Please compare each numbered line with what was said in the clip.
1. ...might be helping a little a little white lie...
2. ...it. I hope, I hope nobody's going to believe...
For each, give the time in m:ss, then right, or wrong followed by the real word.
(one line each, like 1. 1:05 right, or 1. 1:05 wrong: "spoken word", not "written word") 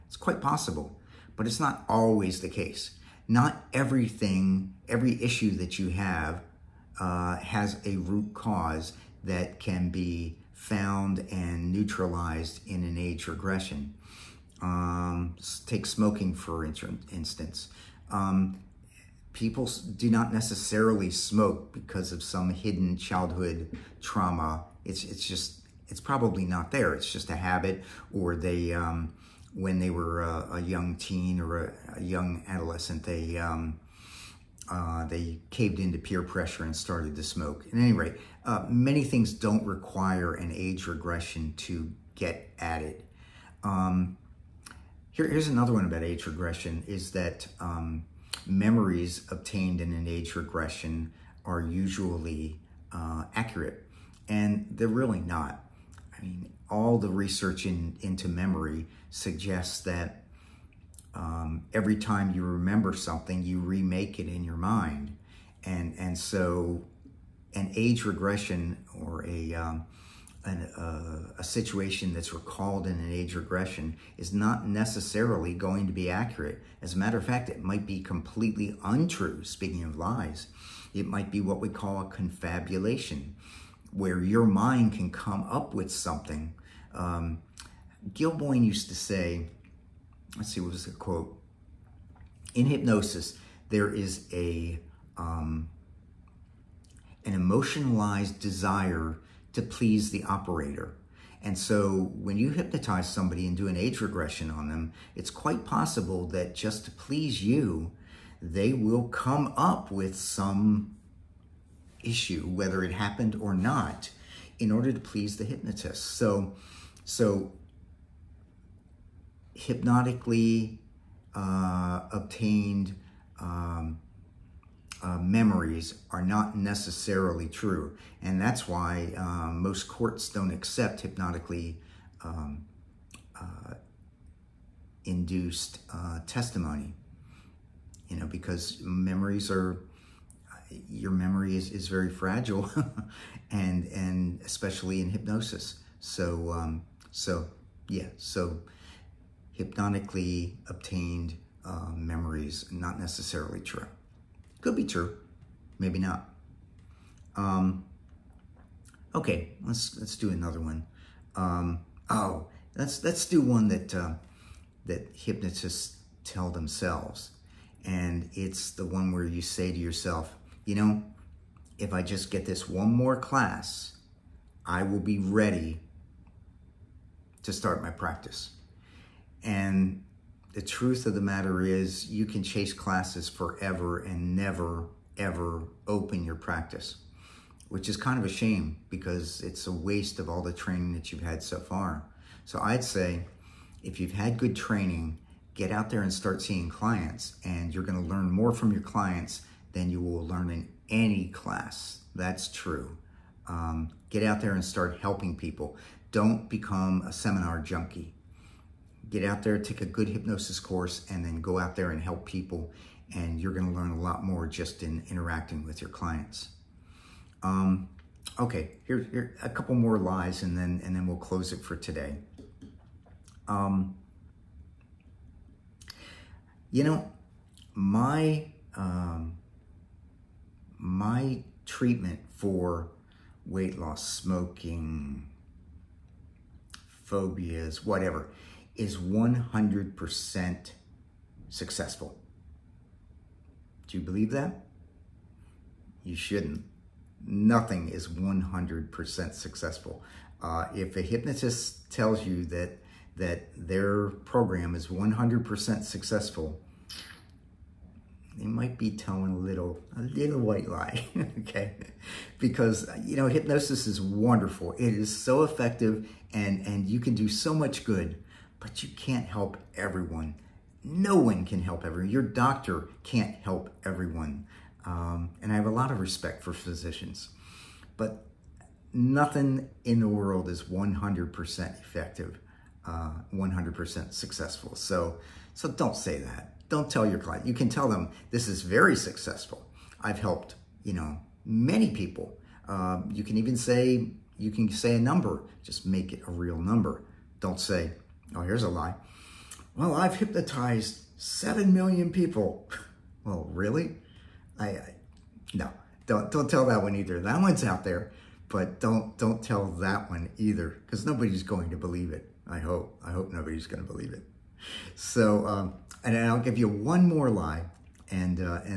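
1. 4:18 wrong: "telling", not "helping"
2. 5:12 right.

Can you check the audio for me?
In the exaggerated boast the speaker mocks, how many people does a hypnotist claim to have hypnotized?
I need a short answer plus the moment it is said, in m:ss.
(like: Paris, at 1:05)
7 million, at 5:01.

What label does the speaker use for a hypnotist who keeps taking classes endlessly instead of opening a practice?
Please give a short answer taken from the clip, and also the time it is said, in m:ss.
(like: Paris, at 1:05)
Seminar junkie, at 3:27.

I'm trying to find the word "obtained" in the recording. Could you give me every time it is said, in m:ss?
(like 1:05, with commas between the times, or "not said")
0:49, 2:02, 2:30.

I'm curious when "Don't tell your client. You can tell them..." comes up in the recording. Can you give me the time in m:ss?
4:46.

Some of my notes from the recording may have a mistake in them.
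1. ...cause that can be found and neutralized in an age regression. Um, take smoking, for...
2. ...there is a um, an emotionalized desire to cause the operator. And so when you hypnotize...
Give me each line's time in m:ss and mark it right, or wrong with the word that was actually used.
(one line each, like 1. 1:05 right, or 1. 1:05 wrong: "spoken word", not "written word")
1. 0:08 right
2. 1:33 wrong: "please", not "cause".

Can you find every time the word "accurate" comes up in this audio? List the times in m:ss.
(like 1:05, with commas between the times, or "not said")
0:53, 1:16.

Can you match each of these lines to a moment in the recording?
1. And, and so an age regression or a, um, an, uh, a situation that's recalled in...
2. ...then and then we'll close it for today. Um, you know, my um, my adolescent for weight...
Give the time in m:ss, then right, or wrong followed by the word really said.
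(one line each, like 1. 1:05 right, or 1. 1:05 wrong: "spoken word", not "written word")
1. 1:05 right
2. 3:40 wrong: "treatment", not "adolescent".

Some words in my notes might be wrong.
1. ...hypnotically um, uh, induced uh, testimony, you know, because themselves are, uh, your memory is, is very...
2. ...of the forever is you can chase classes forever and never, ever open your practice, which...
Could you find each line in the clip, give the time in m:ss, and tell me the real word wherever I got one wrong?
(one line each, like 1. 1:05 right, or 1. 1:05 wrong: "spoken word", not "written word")
1. 2:11 wrong: "memories", not "themselves"
2. 3:01 wrong: "matter", not "forever".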